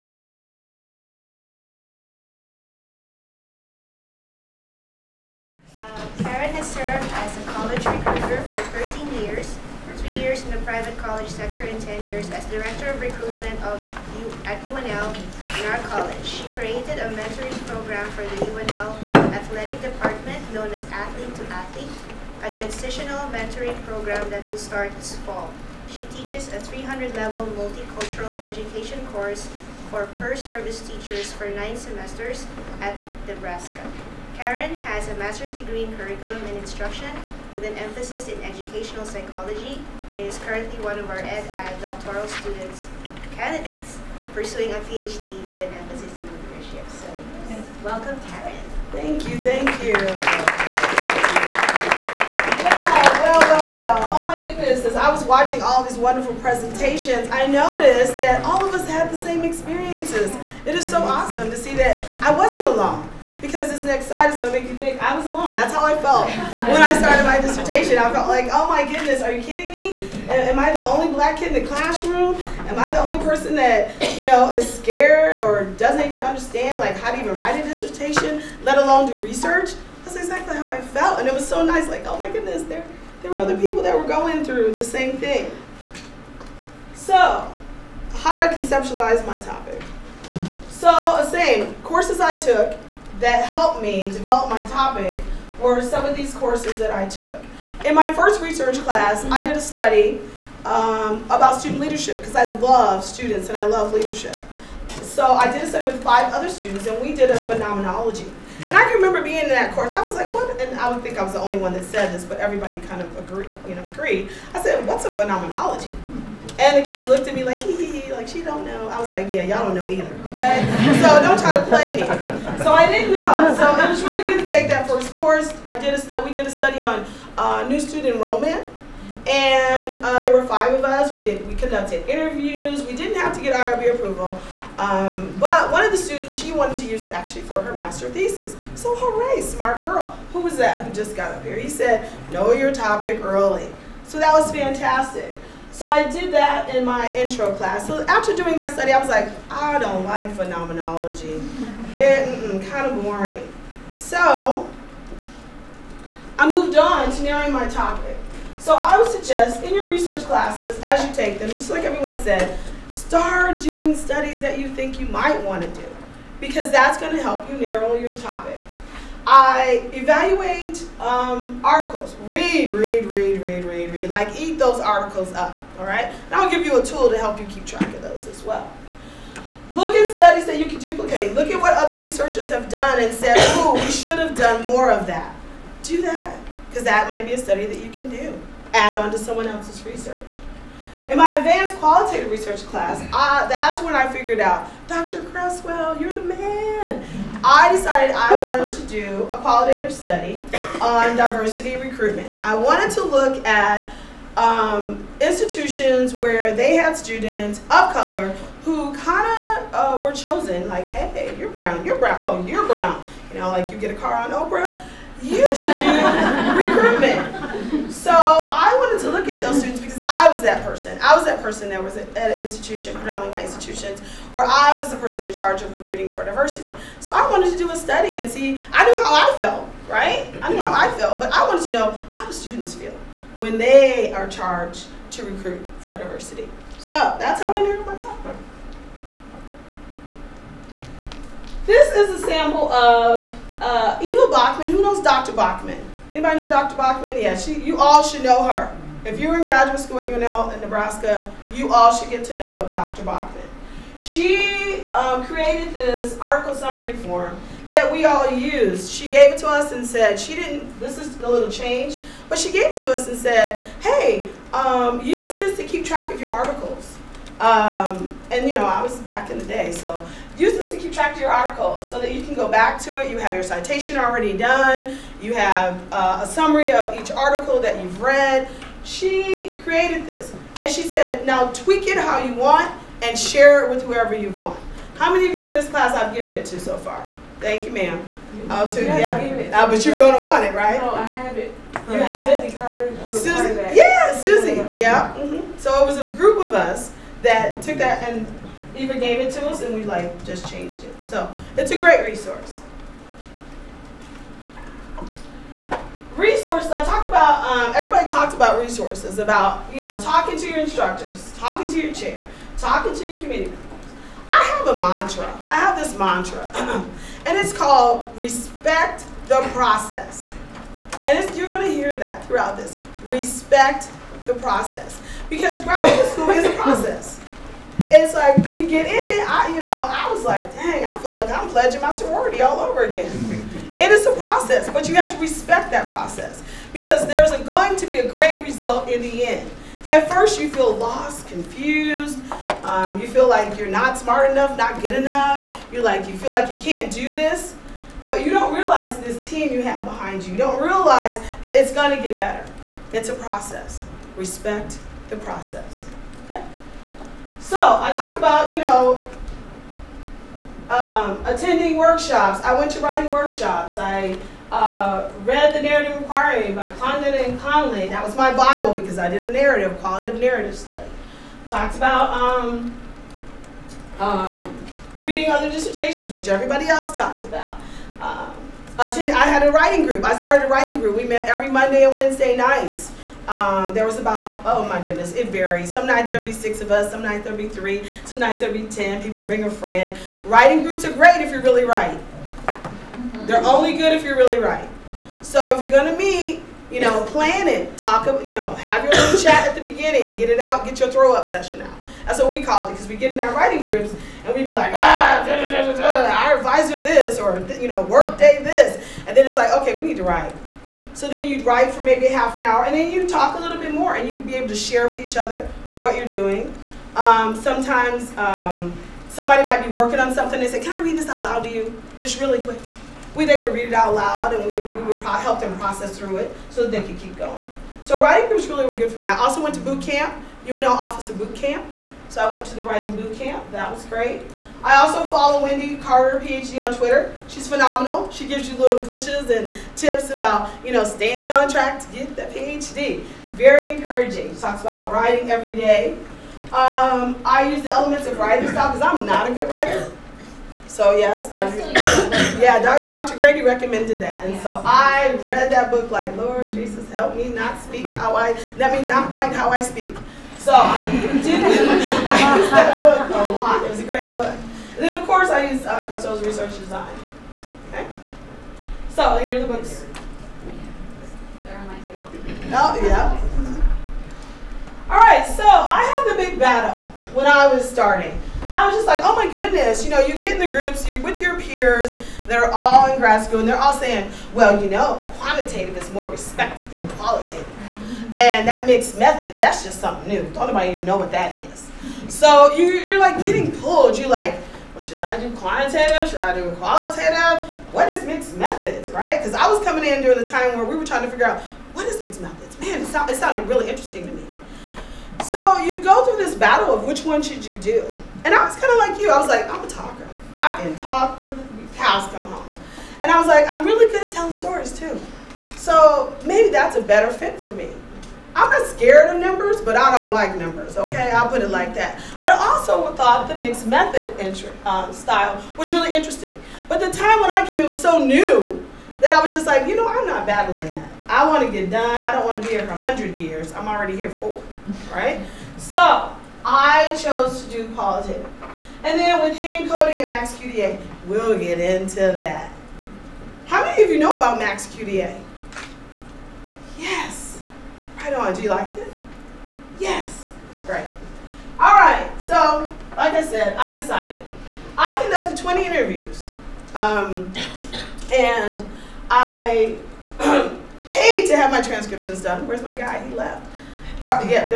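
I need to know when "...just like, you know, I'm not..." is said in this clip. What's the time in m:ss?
8:49.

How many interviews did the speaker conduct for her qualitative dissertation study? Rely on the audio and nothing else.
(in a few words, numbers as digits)
20.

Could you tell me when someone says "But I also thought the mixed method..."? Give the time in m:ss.
8:42.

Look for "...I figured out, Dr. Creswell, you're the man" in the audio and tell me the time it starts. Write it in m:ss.
3:13.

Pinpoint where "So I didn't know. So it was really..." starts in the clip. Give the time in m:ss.
2:02.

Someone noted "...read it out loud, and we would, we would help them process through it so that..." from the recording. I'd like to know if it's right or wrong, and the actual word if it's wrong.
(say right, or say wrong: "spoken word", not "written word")
right.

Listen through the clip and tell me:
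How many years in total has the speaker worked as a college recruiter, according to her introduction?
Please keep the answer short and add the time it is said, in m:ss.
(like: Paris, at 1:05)
13, at 0:08.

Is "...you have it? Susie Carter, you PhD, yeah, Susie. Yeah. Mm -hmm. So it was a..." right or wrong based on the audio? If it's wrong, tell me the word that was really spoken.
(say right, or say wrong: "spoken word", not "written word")
wrong: "Susie", not "PhD".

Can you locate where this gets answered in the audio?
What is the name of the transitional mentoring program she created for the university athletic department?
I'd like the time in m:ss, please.
0:20.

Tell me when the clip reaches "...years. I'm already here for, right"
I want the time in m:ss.
8:53.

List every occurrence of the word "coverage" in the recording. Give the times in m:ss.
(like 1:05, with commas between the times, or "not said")
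not said.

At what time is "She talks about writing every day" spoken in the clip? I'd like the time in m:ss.
7:24.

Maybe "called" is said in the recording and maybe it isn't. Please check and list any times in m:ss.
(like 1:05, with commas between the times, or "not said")
5:17, 6:42.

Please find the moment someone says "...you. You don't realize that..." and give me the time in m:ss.
5:50.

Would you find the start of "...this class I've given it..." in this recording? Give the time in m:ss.
4:45.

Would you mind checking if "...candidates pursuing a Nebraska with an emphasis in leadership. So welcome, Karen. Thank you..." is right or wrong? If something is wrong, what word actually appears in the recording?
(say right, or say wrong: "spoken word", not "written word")
wrong: "PhD", not "Nebraska".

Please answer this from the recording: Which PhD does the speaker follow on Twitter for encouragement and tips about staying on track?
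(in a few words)
Wendy Carter.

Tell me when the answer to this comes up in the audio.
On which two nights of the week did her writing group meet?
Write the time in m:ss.
6:21.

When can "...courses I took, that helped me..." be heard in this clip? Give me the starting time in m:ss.
1:31.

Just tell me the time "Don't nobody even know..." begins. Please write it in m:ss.
8:10.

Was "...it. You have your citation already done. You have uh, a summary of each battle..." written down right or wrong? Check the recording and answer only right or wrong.
wrong.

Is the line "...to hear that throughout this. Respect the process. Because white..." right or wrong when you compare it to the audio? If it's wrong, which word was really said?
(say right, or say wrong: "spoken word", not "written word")
wrong: "graduate", not "white".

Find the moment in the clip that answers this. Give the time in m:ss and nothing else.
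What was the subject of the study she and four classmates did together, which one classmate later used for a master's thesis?
2:07.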